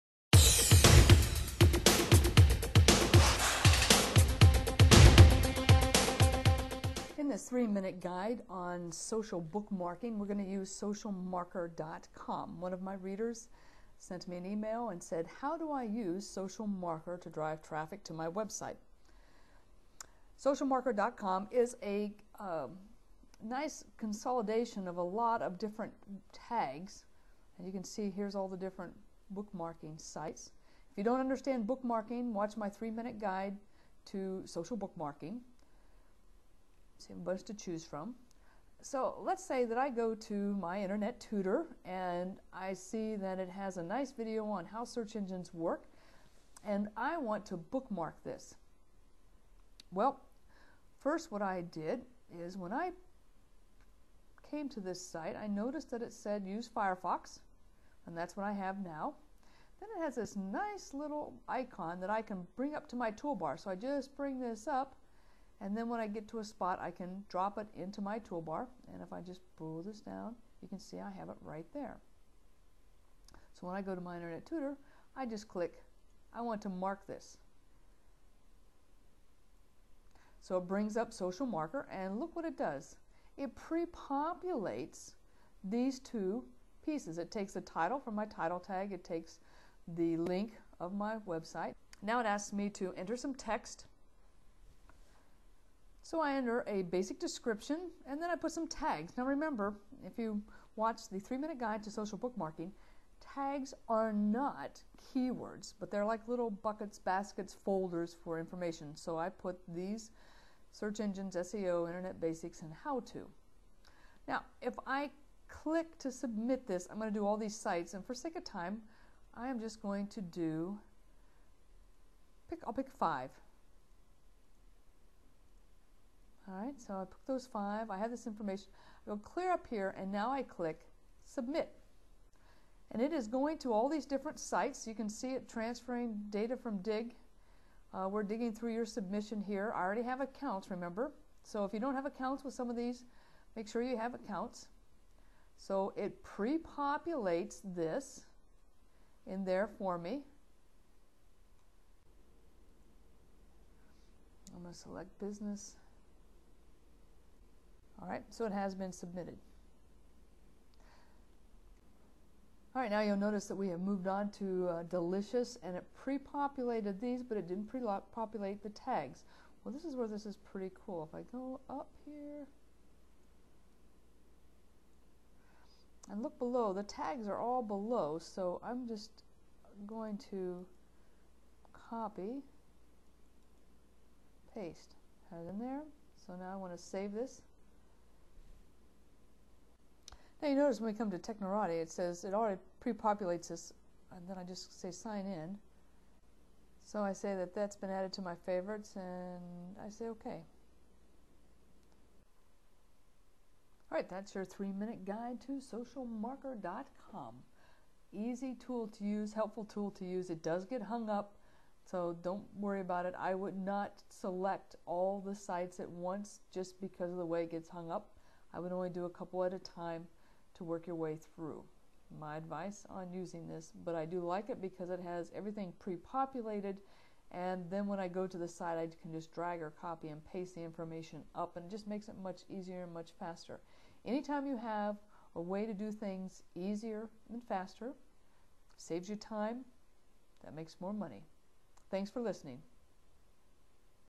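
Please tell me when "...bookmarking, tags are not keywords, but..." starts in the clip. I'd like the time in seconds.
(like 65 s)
102 s.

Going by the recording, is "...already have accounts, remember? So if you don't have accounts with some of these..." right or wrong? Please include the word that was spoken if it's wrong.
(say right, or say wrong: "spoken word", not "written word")
right.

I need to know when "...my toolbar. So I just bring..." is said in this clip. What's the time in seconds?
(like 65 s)
62 s.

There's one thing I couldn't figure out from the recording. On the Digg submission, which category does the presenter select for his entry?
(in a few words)
Business.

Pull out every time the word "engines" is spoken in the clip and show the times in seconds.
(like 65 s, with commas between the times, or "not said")
45 s, 110 s.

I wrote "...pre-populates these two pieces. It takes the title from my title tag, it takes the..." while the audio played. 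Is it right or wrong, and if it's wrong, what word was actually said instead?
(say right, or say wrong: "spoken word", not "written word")
right.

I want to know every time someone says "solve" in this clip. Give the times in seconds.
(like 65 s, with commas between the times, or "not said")
not said.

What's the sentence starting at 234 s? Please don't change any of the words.
Anytime you have a way to do things easier and faster, saves you time, that makes more money.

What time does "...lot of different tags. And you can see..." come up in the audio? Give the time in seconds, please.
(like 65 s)
25 s.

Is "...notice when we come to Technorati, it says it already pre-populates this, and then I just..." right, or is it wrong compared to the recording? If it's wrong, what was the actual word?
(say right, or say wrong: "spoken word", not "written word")
right.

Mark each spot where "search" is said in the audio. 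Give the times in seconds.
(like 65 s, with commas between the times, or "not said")
44 s, 110 s.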